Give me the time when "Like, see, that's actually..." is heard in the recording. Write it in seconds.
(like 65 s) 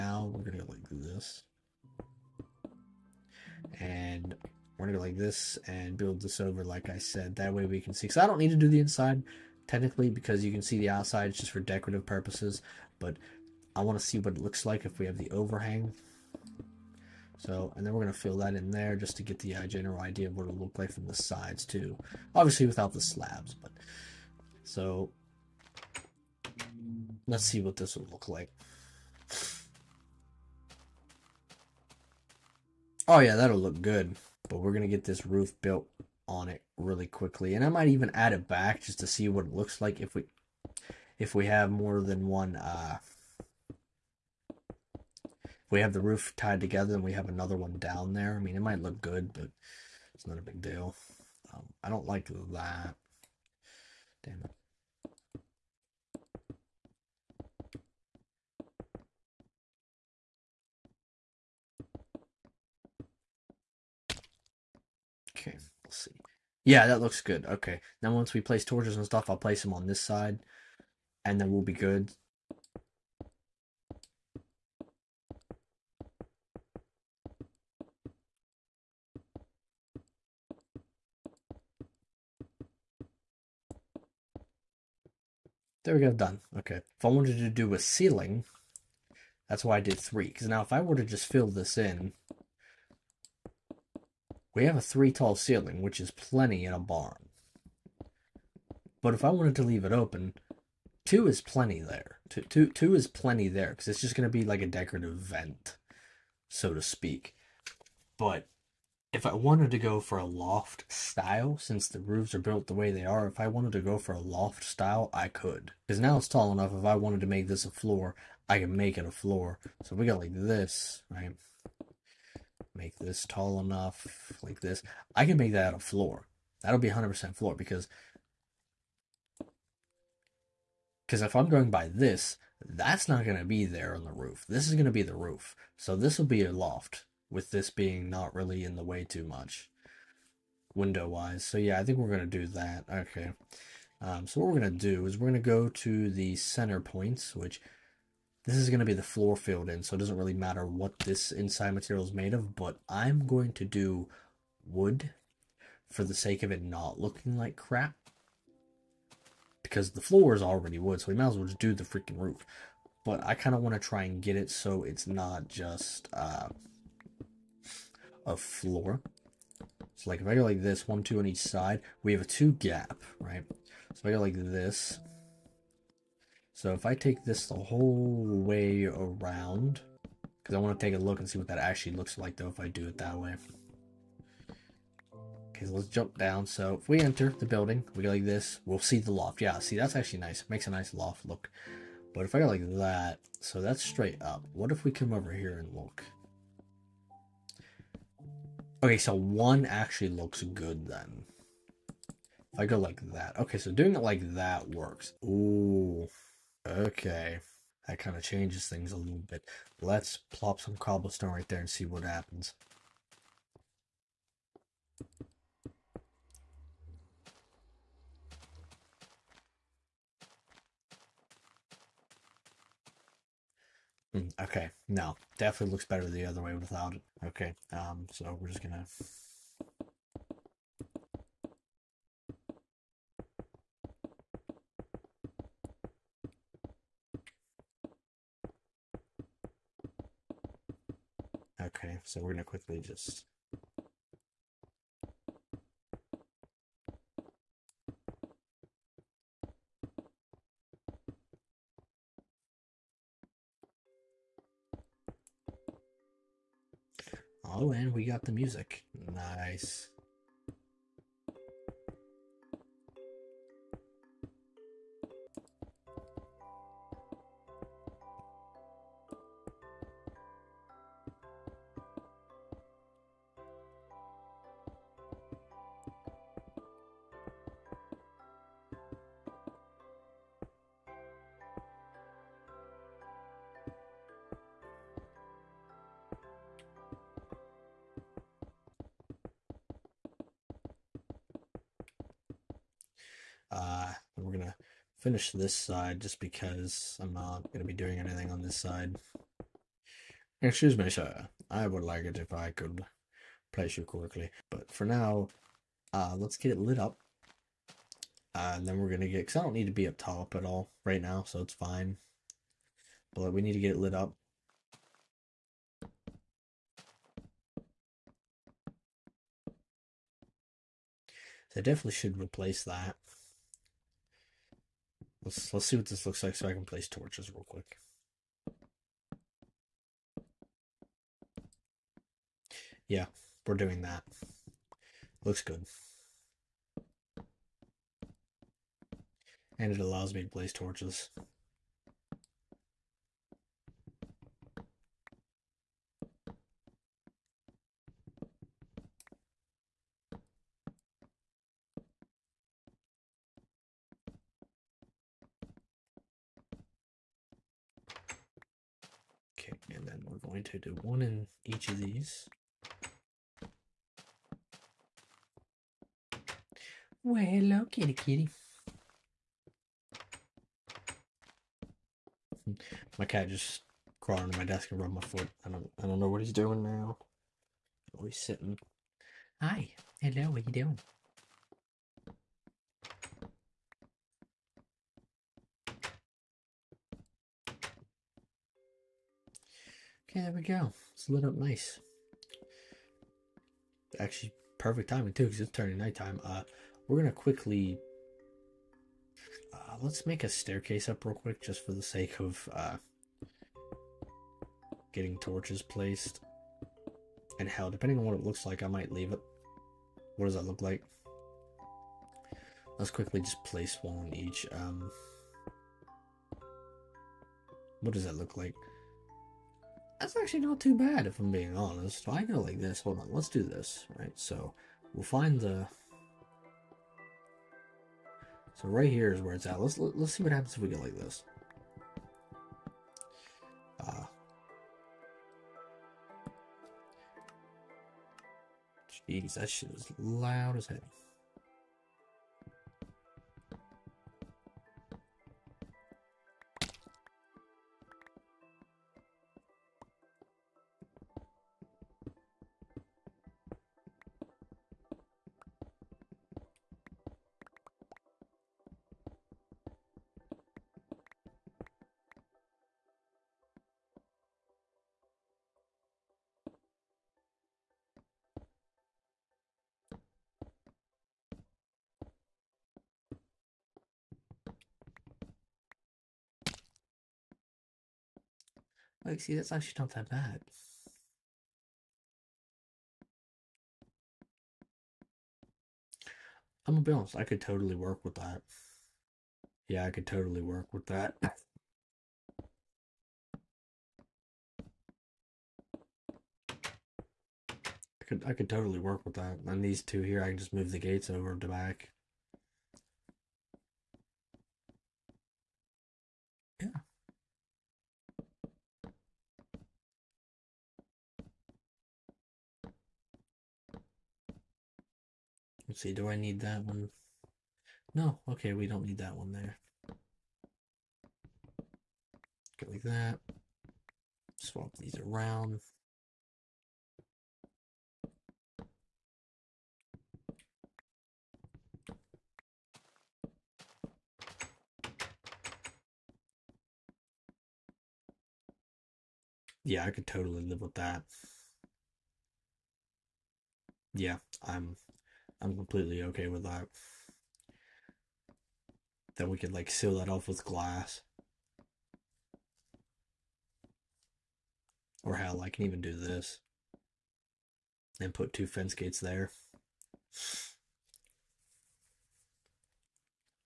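479 s.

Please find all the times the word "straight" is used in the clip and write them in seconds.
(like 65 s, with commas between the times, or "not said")
193 s.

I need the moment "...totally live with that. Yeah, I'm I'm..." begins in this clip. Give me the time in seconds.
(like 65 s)
540 s.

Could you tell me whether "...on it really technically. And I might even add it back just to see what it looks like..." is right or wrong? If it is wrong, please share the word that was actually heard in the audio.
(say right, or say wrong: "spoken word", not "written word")
wrong: "quickly", not "technically".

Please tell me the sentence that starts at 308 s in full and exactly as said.
Uh, and then we're going to get, because I don't need to be up top at all right now, so it's fine.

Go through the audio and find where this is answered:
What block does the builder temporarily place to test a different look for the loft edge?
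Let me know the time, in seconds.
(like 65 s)
210 s.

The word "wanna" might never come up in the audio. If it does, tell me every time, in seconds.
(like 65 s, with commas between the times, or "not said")
13 s.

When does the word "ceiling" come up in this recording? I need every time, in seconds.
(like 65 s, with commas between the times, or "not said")
87 s, 95 s.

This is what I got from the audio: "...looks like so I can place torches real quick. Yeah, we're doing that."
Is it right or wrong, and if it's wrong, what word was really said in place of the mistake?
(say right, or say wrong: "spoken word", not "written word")
right.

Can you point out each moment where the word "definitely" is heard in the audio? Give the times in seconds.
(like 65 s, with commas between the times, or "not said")
225 s, 321 s.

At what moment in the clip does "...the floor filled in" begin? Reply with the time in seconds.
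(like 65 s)
148 s.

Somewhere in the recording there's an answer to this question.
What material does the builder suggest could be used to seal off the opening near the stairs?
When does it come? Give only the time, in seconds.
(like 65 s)
550 s.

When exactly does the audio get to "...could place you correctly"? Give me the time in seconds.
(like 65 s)
302 s.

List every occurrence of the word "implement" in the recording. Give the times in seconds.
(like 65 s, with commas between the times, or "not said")
not said.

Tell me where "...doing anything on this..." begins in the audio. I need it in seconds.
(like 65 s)
297 s.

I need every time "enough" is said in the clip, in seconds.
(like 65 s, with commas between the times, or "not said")
116 s, 123 s.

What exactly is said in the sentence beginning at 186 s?
So if we enter the building, we go like this, we'll see the loft.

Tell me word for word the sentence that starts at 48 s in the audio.
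I mean, it might look good, but it's not a big deal.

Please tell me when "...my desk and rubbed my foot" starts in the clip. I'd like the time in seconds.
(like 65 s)
374 s.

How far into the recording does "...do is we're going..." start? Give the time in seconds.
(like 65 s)
144 s.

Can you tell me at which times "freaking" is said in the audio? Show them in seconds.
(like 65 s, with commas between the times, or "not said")
161 s.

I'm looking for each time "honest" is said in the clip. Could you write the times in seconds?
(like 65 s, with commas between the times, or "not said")
421 s, 486 s.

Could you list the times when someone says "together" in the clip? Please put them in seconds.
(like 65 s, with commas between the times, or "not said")
46 s.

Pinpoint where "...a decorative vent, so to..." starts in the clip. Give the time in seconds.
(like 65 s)
104 s.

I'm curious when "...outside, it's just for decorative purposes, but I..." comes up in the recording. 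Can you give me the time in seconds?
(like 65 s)
10 s.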